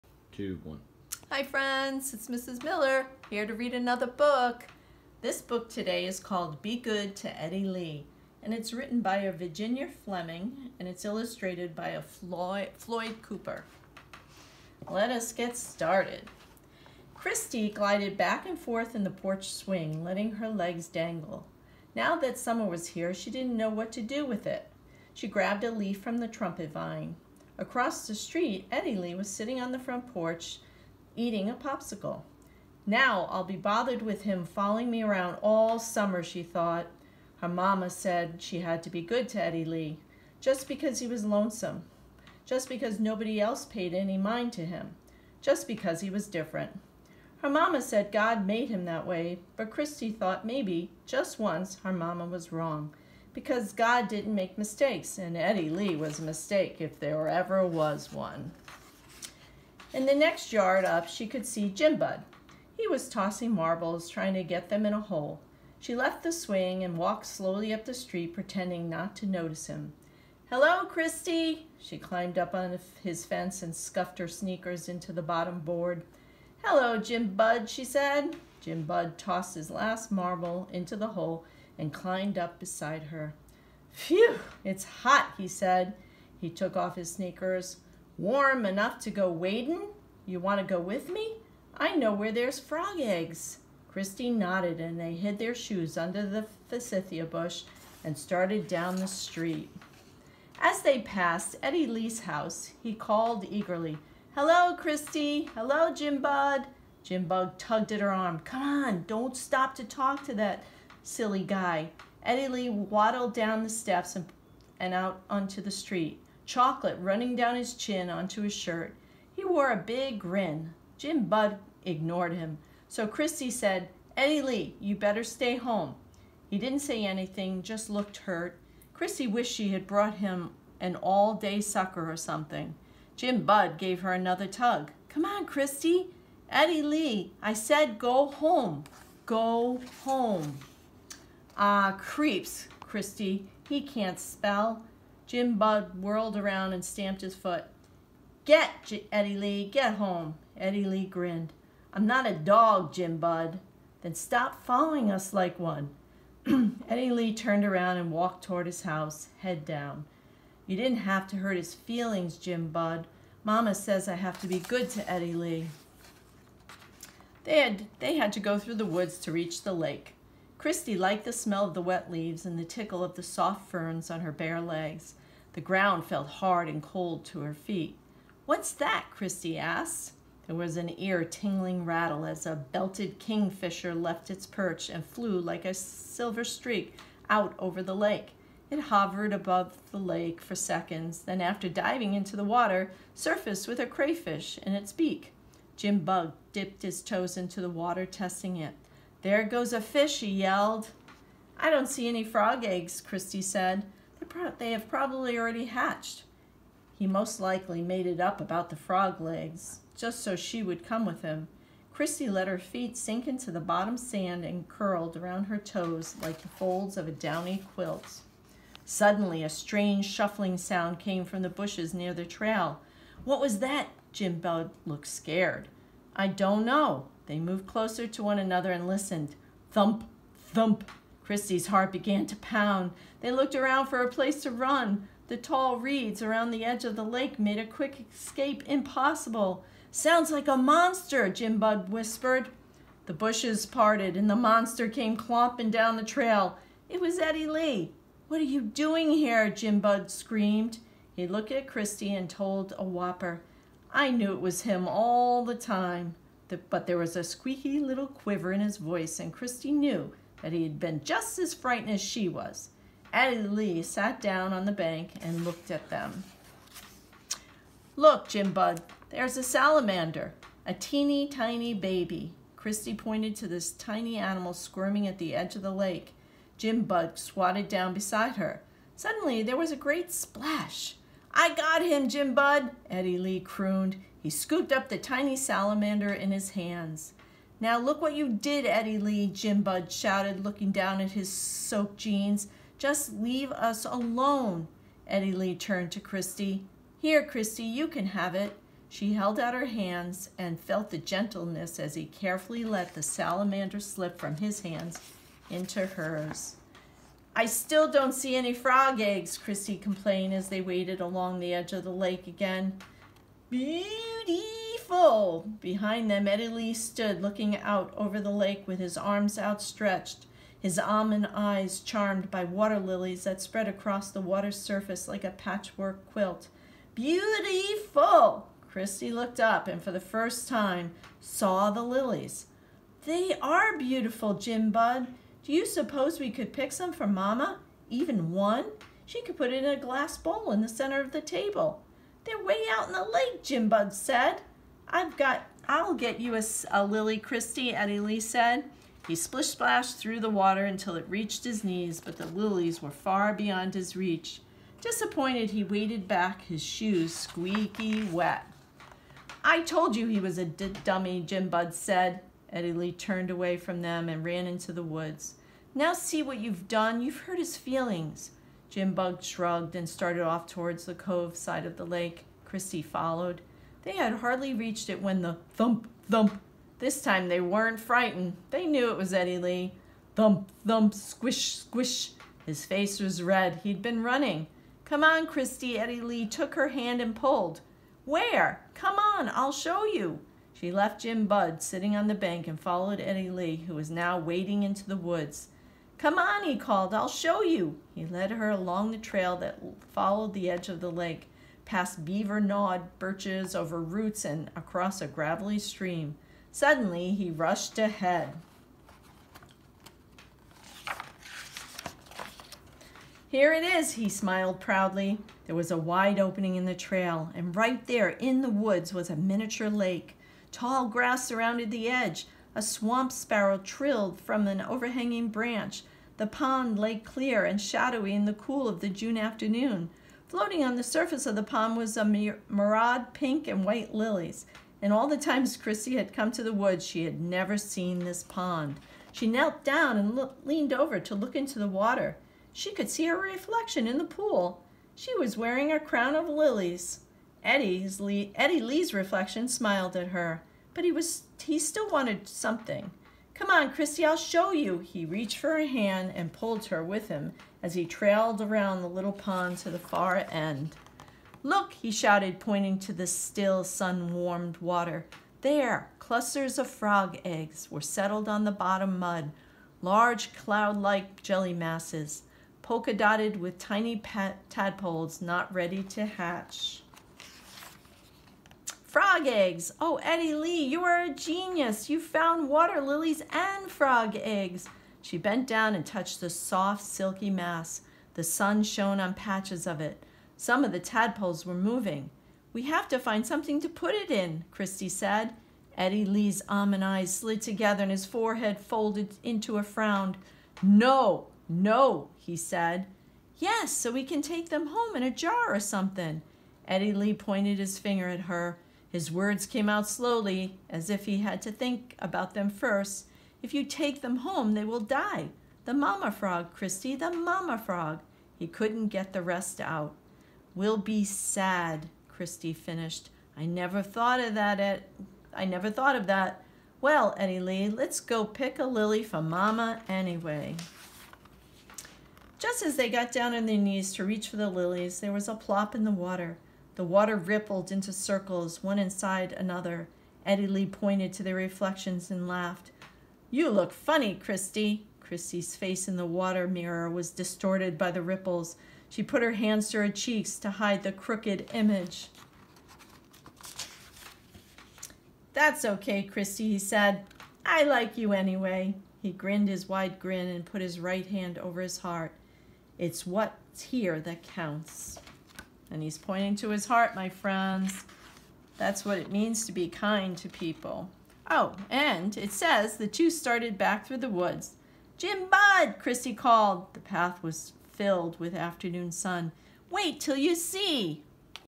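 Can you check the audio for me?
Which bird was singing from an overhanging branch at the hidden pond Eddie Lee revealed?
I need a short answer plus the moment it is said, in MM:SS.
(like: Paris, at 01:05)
Swamp sparrow, at 07:02.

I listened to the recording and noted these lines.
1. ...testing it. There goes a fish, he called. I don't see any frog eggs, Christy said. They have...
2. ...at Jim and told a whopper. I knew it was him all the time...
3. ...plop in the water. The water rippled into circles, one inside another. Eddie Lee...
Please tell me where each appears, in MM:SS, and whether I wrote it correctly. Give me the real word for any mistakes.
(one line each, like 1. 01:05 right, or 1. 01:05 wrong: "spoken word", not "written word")
1. 03:18 wrong: "yelled", not "called"
2. 04:11 wrong: "Christy", not "Jim"
3. 08:55 right.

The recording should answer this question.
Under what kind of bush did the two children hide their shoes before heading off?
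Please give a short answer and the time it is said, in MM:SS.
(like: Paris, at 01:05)
Forsythia bush, at 01:36.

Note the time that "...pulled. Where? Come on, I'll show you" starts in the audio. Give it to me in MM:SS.
06:27.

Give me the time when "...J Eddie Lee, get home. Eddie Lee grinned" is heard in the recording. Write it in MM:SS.
02:28.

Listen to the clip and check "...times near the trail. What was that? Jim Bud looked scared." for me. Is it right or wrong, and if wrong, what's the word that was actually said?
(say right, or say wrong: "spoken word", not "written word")
wrong: "bushes", not "times".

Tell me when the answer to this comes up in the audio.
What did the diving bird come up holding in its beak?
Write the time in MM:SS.
03:13.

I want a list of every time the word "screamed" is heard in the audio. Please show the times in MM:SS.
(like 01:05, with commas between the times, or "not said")
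04:10.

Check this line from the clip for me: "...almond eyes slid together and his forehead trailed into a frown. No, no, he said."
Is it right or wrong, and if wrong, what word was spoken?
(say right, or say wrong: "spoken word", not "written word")
wrong: "folded", not "trailed".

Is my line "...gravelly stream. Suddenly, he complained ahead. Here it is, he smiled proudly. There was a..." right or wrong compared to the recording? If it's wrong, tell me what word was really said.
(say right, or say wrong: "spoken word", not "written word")
wrong: "rushed", not "complained".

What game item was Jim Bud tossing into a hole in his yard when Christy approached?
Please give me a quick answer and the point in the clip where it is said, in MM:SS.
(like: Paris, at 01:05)
Marbles, at 01:03.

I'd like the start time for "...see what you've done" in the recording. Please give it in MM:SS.
06:05.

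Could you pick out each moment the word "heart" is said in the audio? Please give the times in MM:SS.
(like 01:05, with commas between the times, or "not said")
03:51, 09:21, 09:26.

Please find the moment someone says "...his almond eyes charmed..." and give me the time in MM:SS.
05:20.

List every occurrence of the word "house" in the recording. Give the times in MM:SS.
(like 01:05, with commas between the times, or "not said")
01:42, 02:38.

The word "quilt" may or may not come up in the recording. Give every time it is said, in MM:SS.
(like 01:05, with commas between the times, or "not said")
03:37, 05:26.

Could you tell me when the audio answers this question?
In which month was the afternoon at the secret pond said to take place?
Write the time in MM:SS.
07:08.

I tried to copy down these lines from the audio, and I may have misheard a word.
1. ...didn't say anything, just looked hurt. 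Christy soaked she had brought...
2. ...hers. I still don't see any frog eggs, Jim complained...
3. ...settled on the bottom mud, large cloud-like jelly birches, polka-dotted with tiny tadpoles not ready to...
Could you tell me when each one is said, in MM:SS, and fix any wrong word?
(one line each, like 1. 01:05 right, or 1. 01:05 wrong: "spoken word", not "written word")
1. 02:06 wrong: "wished", not "soaked"
2. 05:05 wrong: "Chrissy", not "Jim"
3. 07:47 wrong: "masses", not "birches".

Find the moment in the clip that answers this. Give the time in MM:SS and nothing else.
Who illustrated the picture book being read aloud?
00:12.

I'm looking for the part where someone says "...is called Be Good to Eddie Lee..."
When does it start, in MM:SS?
00:06.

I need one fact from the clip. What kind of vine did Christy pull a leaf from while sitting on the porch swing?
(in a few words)
Trumpet vine.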